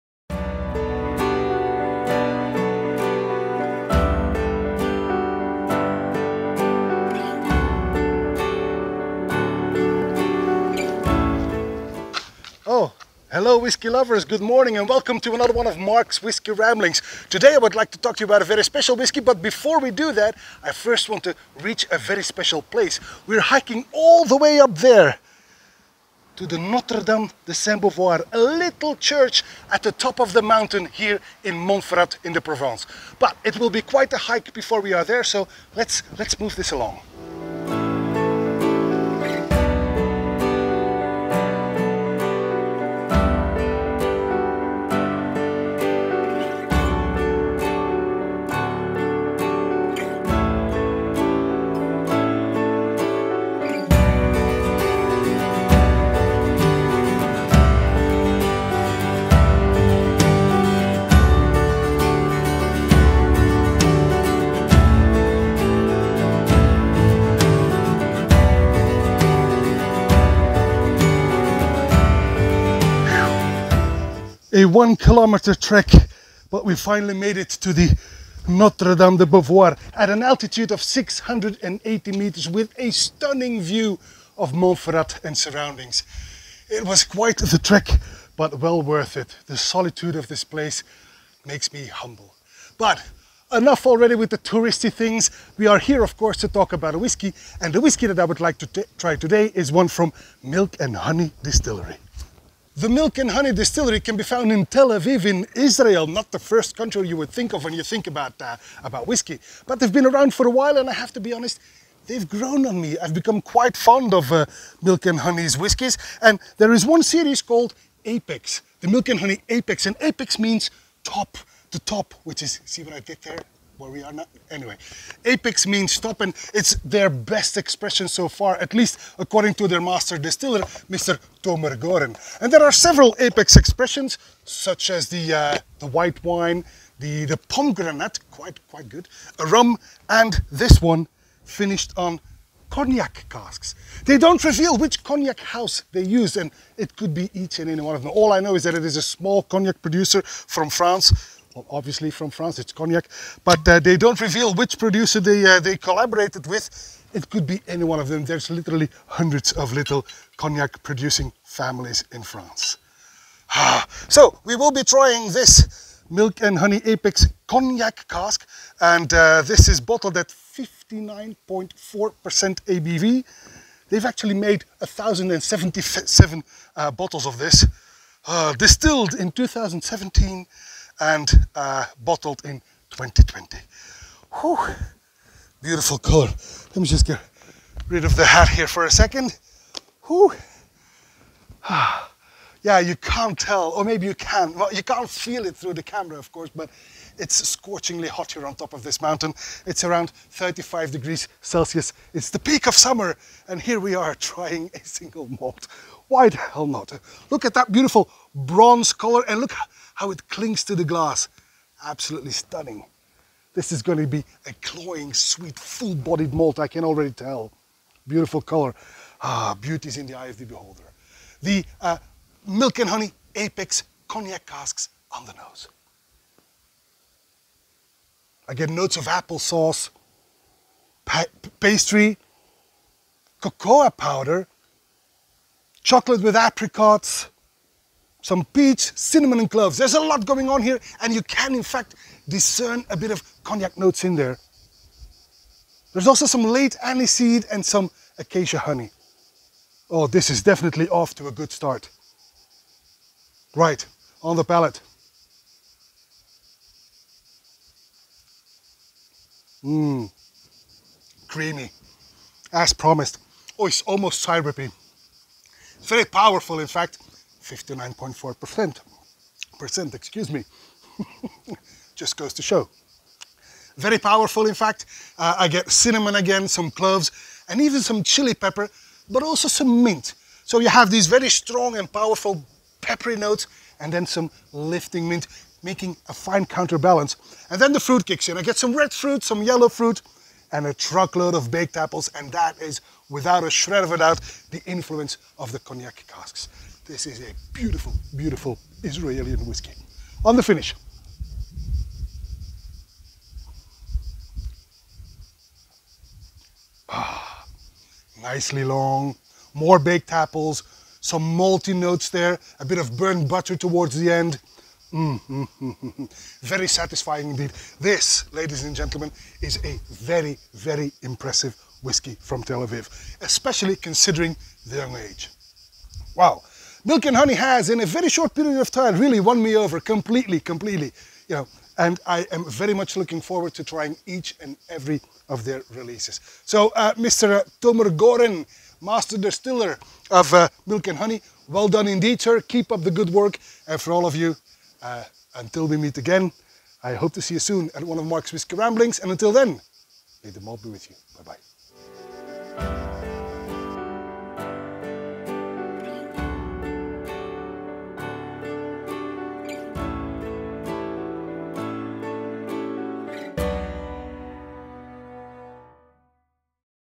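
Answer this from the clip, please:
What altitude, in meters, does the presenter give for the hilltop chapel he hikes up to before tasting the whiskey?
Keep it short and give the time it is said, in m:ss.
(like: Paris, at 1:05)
680 meters, at 1:20.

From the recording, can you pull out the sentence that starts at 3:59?
There's a lot going on here and you can in fact discern a bit of cognac notes in there.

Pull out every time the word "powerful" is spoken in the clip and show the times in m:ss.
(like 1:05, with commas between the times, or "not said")
4:26, 4:34, 4:41.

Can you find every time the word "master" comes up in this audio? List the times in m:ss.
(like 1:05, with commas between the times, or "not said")
2:09, 5:38.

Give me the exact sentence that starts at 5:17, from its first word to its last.
This, ladies and gentlemen, is a very, very impressive whiskey from Tel Aviv, especially considering the young age.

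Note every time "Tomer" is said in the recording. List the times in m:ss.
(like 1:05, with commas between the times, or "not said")
2:11, 5:37.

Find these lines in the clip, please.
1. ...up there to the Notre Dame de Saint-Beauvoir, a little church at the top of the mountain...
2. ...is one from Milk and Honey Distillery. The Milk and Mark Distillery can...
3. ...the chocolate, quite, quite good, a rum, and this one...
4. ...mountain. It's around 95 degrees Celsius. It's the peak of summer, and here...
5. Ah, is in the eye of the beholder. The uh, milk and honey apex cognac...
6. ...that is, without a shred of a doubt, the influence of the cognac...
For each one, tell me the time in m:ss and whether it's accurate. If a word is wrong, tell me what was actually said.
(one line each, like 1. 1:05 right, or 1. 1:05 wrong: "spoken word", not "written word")
1. 0:24 right
2. 1:39 wrong: "Honey", not "Mark"
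3. 2:17 wrong: "pomegranate", not "chocolate"
4. 3:19 wrong: "35", not "95"
5. 3:39 right
6. 4:52 right.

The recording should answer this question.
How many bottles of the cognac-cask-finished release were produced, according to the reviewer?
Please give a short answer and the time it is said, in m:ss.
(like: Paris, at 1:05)
1077, at 2:54.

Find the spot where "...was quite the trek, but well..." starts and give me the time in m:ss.
1:26.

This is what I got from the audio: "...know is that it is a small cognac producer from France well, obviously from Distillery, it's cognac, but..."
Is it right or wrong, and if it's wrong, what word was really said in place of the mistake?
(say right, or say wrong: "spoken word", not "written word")
wrong: "France", not "Distillery".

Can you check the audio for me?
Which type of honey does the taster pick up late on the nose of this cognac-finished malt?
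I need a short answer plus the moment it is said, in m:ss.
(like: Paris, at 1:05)
acacia honey, at 4:08.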